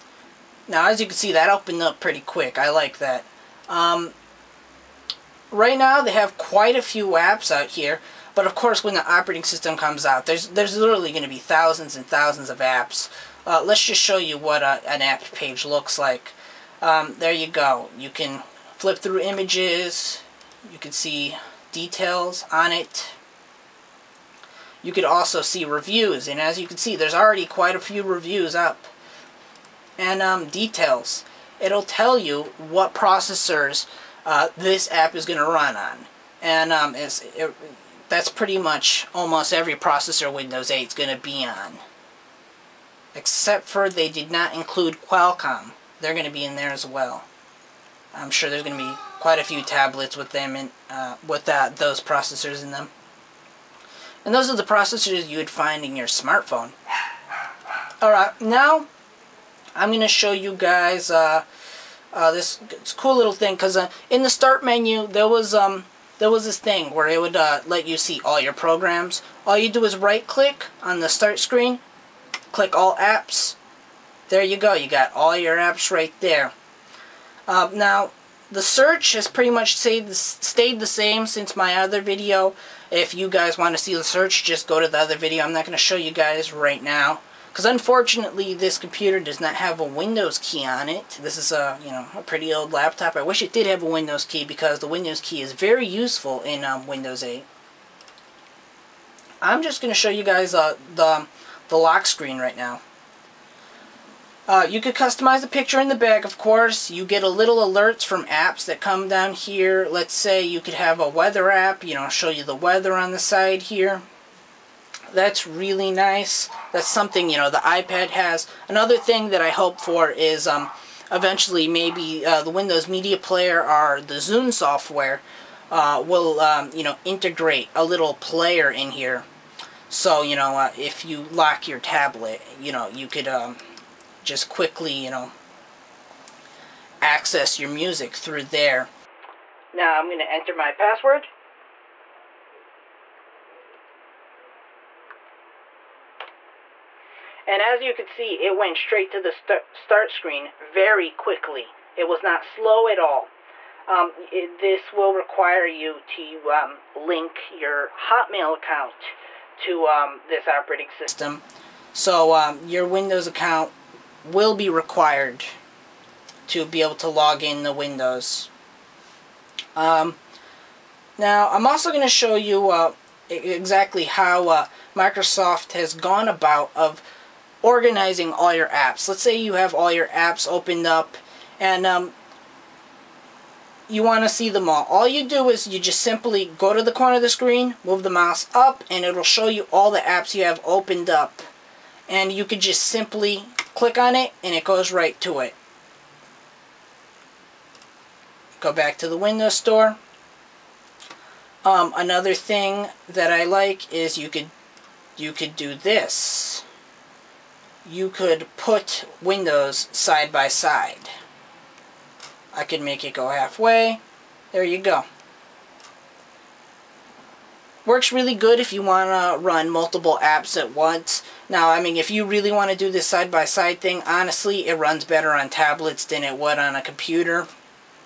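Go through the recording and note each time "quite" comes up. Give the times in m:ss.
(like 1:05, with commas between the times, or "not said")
0:06, 0:27, 0:49.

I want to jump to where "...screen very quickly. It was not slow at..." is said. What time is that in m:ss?
2:30.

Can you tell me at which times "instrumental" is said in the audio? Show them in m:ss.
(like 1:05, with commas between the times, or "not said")
not said.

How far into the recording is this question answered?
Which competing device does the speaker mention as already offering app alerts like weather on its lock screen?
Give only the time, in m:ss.
1:57.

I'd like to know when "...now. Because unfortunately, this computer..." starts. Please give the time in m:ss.
1:26.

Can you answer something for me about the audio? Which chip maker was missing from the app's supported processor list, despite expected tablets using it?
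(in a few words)
Qualcomm.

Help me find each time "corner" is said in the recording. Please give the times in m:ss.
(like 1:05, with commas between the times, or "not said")
3:06.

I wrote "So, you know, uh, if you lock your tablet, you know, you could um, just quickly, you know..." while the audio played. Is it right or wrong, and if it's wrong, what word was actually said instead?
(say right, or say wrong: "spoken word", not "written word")
right.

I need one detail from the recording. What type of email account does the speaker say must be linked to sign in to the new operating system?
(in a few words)
Hotmail.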